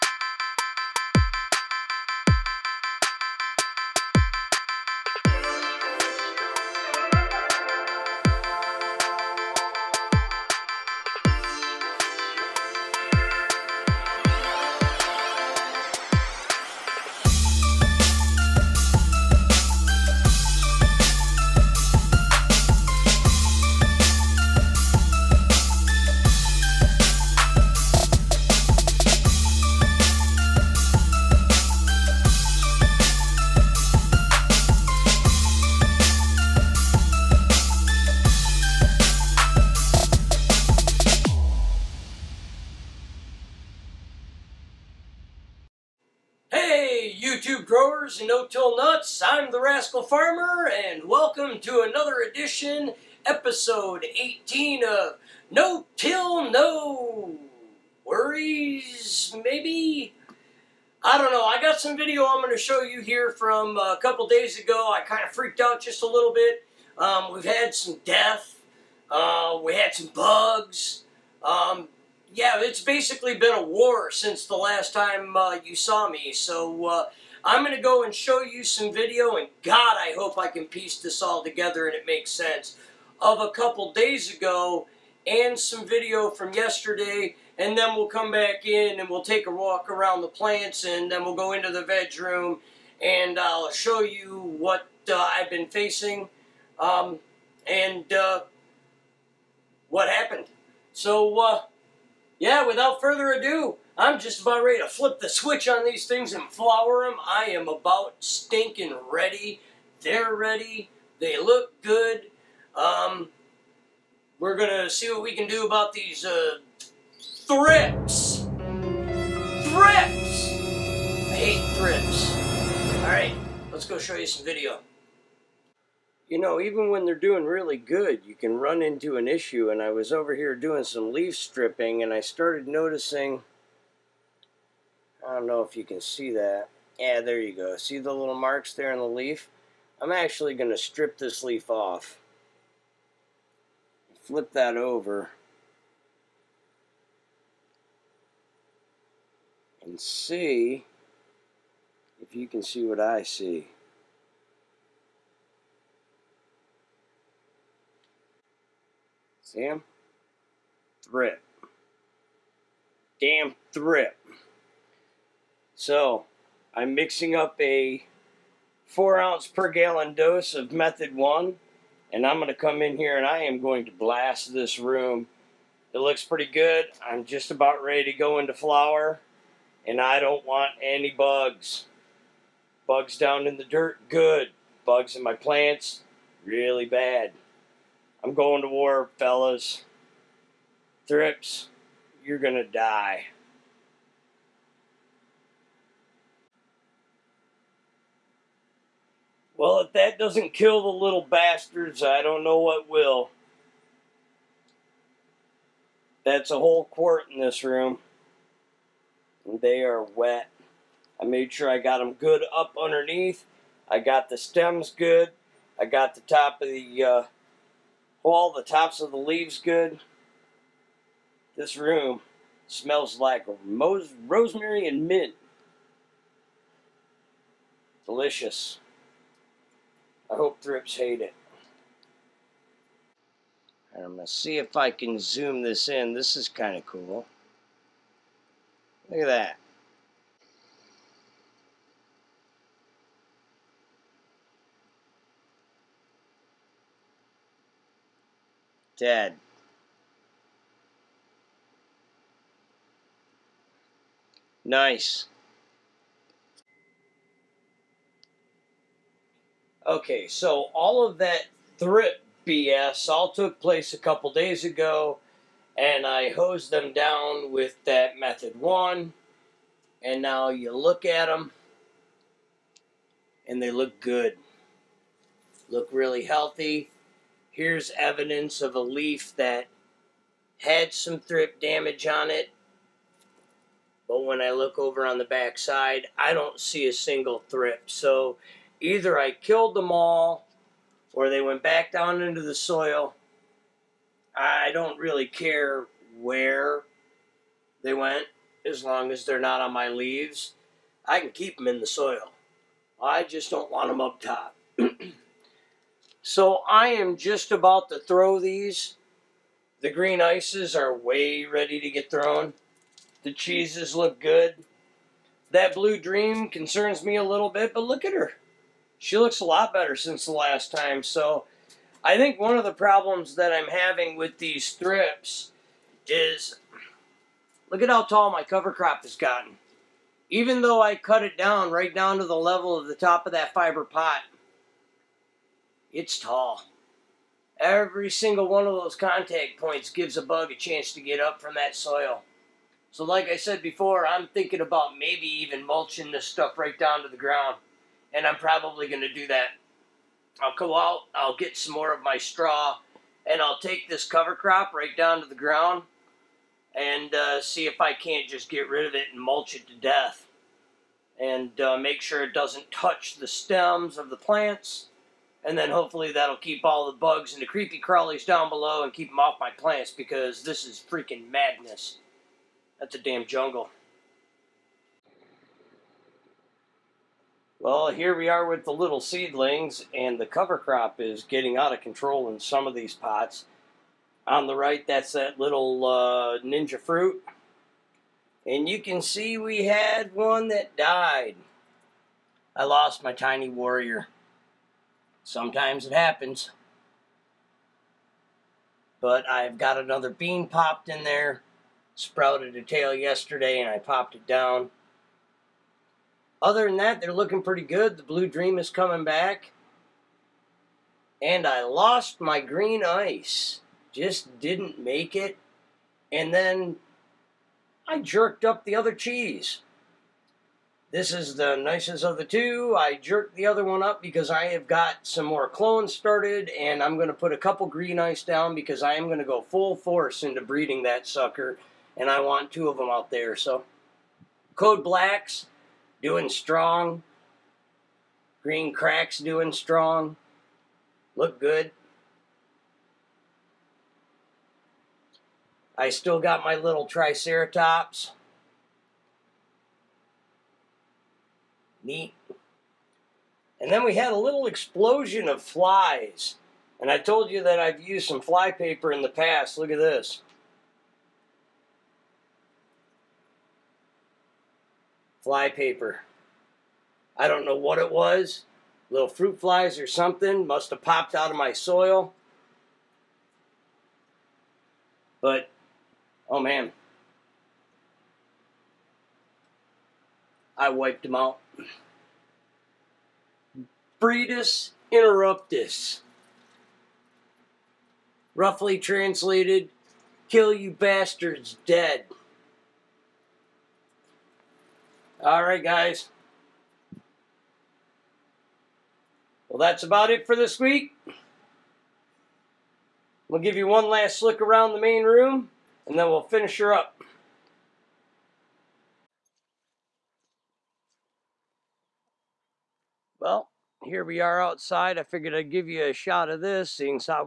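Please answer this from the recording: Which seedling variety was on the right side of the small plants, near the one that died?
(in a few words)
Ninja Fruit.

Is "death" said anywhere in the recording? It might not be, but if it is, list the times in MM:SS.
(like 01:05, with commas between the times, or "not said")
01:08, 05:59.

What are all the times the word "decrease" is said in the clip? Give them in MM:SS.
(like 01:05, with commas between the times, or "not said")
not said.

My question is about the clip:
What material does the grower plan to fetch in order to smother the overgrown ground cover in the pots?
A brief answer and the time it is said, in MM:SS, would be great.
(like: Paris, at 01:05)
Straw, at 05:52.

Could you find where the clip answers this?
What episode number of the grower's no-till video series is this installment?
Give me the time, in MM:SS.
00:53.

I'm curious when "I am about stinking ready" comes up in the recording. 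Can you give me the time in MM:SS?
01:47.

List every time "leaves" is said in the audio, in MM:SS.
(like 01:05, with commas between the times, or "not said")
03:39, 04:59.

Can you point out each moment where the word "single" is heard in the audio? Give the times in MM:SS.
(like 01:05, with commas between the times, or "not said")
04:46, 05:38.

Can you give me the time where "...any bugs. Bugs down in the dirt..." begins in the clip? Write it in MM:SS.
03:00.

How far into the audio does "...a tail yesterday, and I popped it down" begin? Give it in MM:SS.
06:42.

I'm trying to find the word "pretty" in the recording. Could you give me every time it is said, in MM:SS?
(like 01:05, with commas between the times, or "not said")
02:56, 06:47.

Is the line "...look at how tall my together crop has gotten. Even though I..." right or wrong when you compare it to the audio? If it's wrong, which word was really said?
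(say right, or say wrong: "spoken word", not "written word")
wrong: "cover", not "together".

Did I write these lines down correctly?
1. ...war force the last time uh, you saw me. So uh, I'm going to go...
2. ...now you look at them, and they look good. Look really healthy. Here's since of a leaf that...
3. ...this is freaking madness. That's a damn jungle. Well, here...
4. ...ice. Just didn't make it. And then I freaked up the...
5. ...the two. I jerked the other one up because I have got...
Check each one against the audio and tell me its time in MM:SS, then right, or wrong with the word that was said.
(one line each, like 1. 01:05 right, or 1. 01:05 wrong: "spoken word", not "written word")
1. 01:13 wrong: "since", not "force"
2. 04:30 wrong: "evidence", not "since"
3. 06:10 right
4. 06:52 wrong: "jerked", not "freaked"
5. 07:02 right.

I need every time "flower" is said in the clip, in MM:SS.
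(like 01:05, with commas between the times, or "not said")
01:46, 02:58.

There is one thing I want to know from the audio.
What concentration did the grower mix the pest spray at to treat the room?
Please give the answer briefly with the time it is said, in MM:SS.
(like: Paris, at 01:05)
4 ounces per gallon, at 02:48.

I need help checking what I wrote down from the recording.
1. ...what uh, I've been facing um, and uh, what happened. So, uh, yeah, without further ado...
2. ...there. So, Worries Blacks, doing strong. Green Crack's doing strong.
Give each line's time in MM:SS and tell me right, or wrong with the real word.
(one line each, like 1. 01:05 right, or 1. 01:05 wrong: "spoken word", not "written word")
1. 01:34 right
2. 07:13 wrong: "Code", not "Worries".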